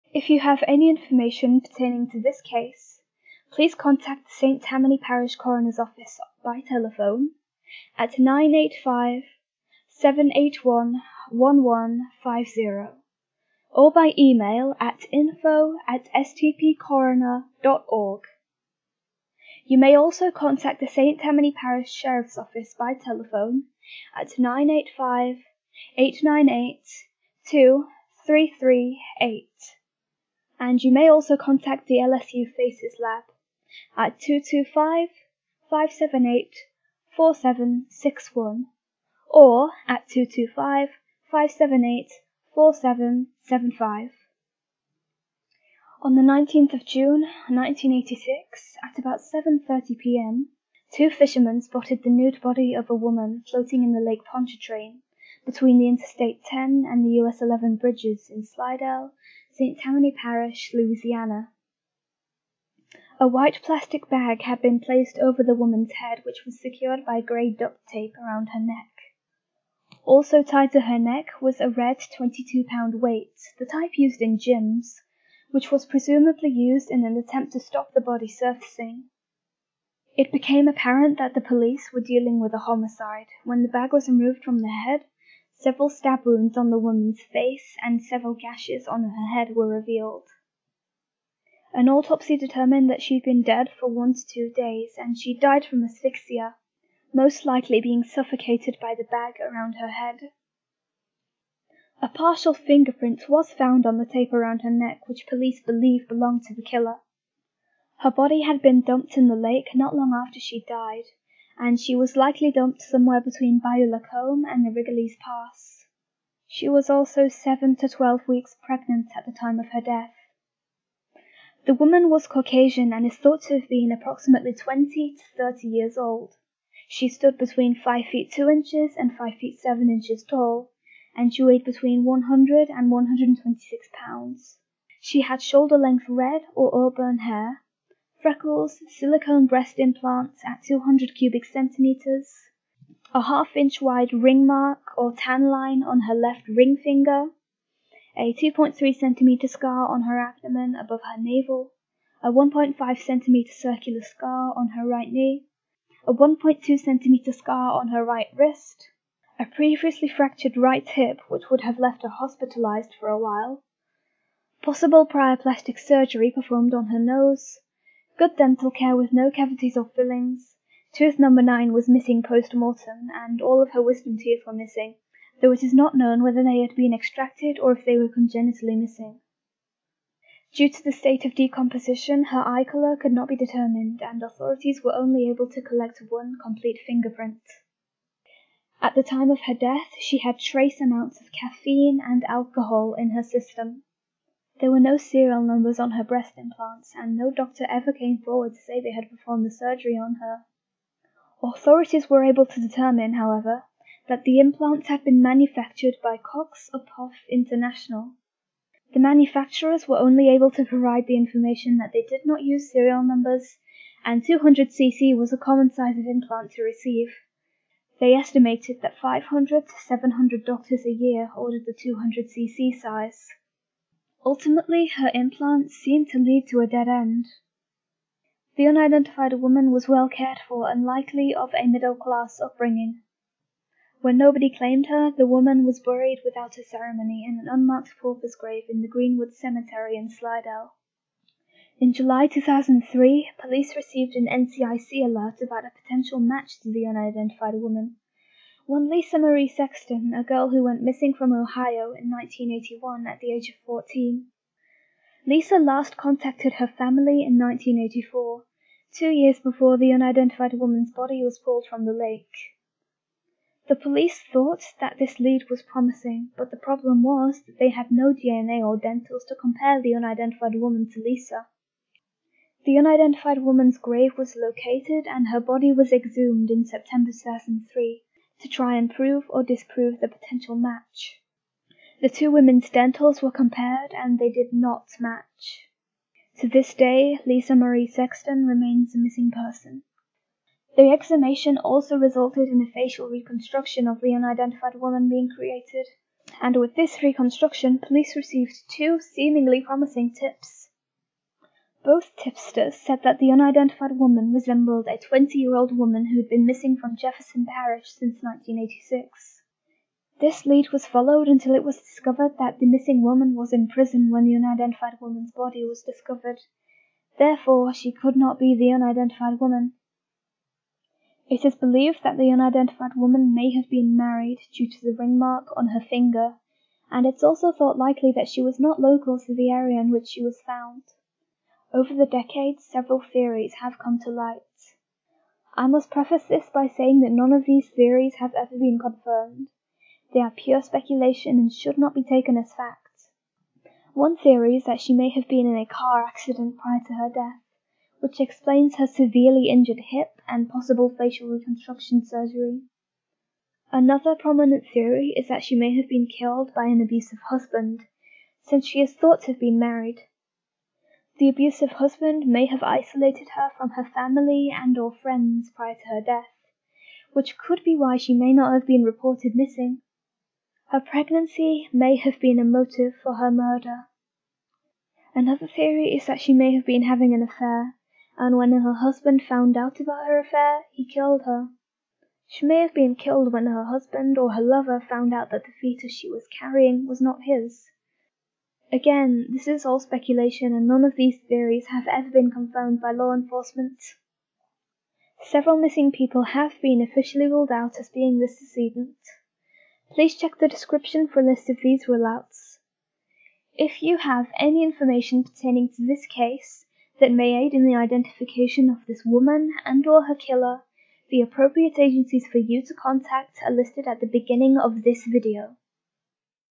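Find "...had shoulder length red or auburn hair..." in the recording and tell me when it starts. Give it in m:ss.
2:15.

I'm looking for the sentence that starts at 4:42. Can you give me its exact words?
The two women's dentals were compared and they did not match.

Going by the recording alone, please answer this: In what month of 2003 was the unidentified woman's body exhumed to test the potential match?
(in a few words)
September.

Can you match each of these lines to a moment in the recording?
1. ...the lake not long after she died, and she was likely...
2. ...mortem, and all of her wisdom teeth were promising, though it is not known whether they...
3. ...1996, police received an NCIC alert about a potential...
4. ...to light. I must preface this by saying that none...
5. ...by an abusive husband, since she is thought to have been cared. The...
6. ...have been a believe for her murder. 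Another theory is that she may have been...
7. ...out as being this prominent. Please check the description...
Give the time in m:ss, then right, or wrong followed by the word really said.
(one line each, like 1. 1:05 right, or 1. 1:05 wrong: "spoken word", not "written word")
1. 1:49 right
2. 2:52 wrong: "missing", not "promising"
3. 4:02 wrong: "2003", not "1996"
4. 5:33 right
5. 5:56 wrong: "married", not "cared"
6. 6:11 wrong: "motive", not "believe"
7. 6:37 wrong: "decedent", not "prominent".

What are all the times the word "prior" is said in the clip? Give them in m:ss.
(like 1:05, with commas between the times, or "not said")
2:45, 5:46, 6:05.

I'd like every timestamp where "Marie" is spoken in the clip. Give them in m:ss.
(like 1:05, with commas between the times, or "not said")
4:09, 4:47.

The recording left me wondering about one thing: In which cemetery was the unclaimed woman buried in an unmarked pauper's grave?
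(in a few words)
Greenwood Cemetery.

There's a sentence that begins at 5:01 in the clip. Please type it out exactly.
Both tipsters said that the unidentified woman resembled a 20-year-old woman who had been missing from Jefferson Parish since 1986.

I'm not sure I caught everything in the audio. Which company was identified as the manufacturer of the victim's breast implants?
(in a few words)
Cox Uphoff International.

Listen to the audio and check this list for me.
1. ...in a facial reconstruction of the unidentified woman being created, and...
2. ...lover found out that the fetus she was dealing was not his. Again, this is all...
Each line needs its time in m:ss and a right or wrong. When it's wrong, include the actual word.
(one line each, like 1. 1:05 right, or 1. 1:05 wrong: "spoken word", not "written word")
1. 4:52 right
2. 6:24 wrong: "carrying", not "dealing".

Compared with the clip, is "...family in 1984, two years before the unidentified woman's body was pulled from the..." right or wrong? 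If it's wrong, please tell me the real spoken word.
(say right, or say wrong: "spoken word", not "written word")
right.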